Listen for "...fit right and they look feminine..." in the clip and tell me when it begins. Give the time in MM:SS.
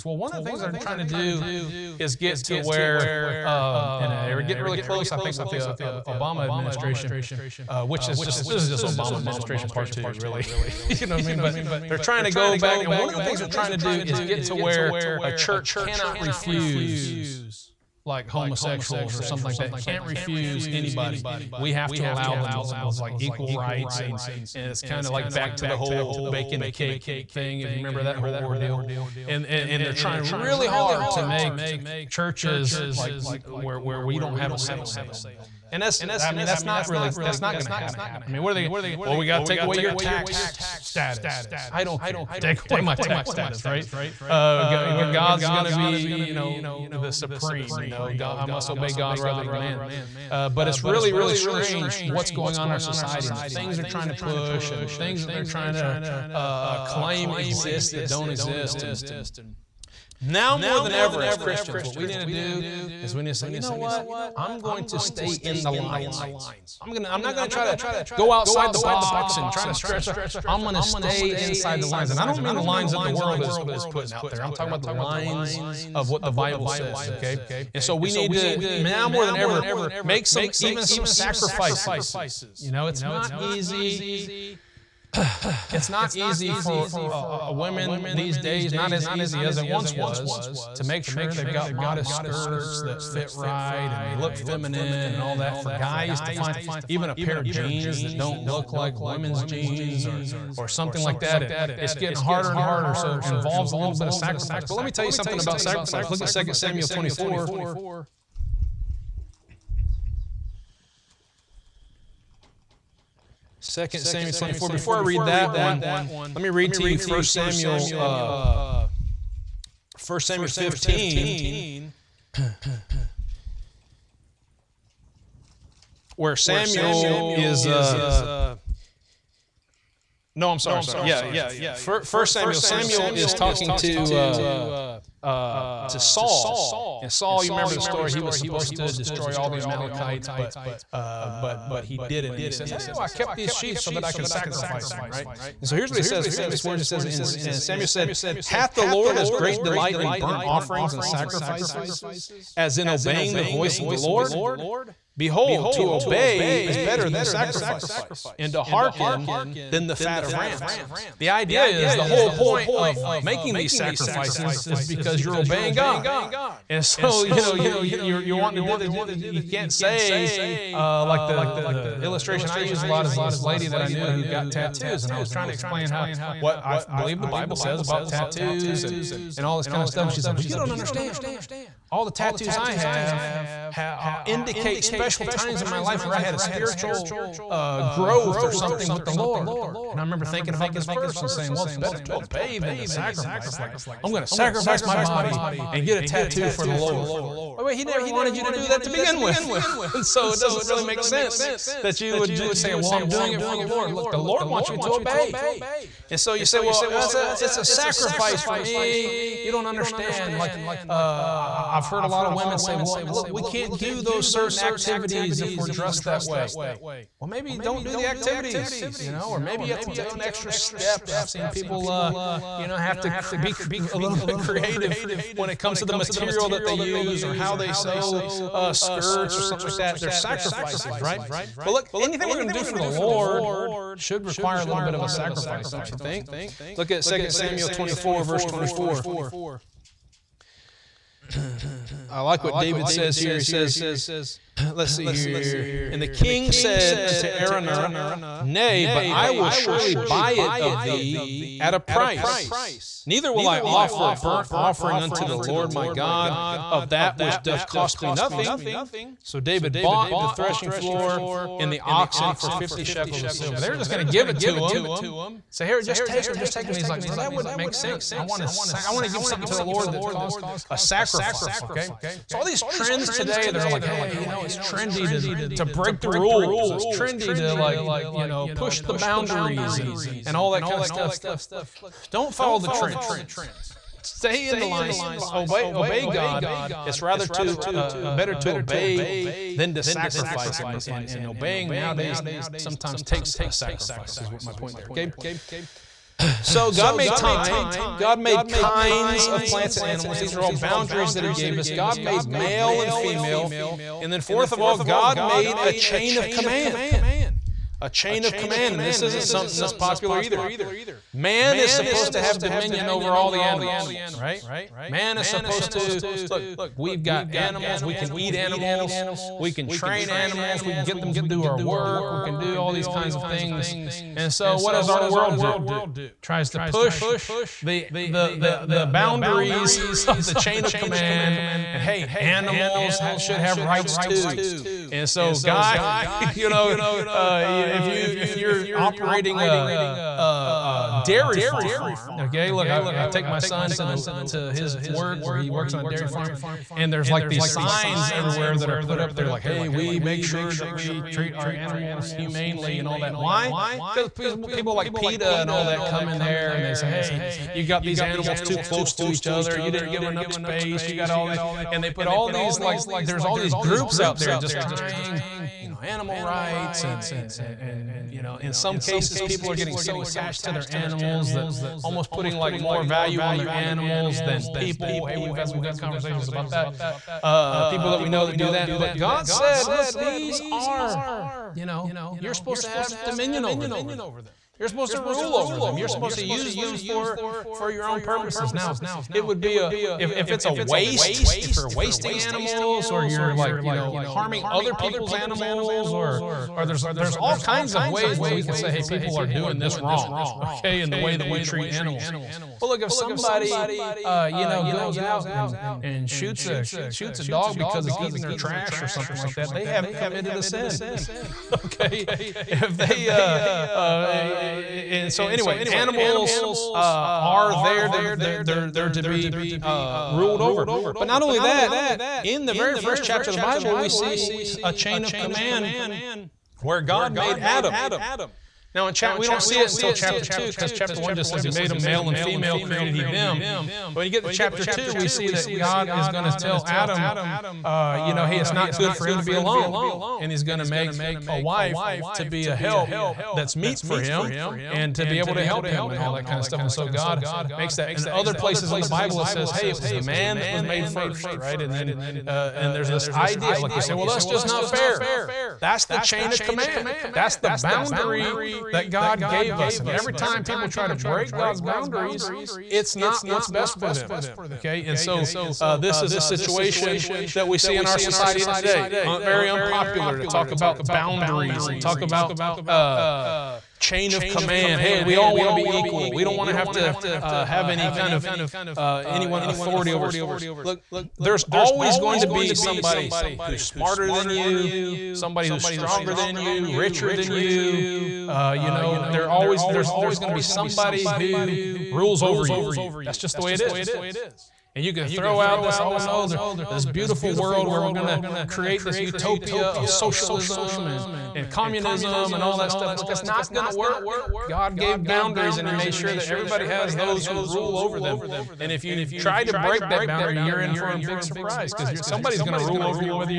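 01:33.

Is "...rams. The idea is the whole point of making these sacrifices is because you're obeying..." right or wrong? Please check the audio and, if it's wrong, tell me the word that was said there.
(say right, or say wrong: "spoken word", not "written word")
right.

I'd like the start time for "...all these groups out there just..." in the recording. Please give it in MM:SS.
06:03.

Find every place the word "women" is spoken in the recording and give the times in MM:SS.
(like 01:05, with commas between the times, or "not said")
01:27, 01:38, 03:32.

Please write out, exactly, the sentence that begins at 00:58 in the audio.
And now more than ever, as Christians, what we need to do is we need to say, you know what?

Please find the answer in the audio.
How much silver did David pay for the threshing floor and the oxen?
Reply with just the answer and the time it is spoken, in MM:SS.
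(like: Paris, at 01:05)
50 shekels, at 04:22.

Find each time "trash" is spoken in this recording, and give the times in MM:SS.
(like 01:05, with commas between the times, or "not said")
06:48.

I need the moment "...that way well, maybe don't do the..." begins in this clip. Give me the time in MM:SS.
03:36.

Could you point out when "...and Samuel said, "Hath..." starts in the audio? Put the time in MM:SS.
02:27.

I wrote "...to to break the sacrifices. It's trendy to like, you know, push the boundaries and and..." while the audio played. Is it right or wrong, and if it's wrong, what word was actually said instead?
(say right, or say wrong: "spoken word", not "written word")
wrong: "rules", not "sacrifices".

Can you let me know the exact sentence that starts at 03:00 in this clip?
And she's like, "Well, you don't understand.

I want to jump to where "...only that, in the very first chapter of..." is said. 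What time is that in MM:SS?
07:01.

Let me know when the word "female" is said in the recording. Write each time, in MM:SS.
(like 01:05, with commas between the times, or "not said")
05:02, 07:12.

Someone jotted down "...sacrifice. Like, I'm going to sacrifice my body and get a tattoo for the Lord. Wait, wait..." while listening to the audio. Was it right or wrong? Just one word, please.
right.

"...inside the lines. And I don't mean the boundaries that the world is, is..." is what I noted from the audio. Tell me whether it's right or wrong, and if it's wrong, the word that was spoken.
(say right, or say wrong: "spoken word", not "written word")
wrong: "lines", not "boundaries".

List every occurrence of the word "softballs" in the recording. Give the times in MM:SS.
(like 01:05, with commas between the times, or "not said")
not said.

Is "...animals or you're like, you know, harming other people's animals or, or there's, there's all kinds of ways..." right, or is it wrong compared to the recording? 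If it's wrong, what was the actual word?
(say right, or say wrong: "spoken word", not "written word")
right.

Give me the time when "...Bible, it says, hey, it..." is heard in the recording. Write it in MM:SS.
07:28.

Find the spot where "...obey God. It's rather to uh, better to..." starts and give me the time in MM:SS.
04:45.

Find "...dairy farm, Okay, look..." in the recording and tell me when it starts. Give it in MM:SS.
05:41.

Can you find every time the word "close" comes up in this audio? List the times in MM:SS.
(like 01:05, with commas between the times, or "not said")
00:04, 05:58.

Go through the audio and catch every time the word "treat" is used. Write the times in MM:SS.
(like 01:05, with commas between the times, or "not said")
05:51, 06:41.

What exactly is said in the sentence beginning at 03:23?
Look, the Lord wants you to obey.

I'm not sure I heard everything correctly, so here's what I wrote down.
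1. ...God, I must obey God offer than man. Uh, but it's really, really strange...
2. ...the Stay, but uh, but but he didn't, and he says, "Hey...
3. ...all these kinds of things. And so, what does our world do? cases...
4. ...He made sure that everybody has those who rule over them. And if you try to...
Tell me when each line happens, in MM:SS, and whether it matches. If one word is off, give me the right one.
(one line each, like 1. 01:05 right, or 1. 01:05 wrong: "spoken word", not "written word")
1. 00:48 wrong: "rather", not "offer"
2. 02:19 wrong: "Amalekites", not "Stay"
3. 05:22 wrong: "tries", not "cases"
4. 08:25 right.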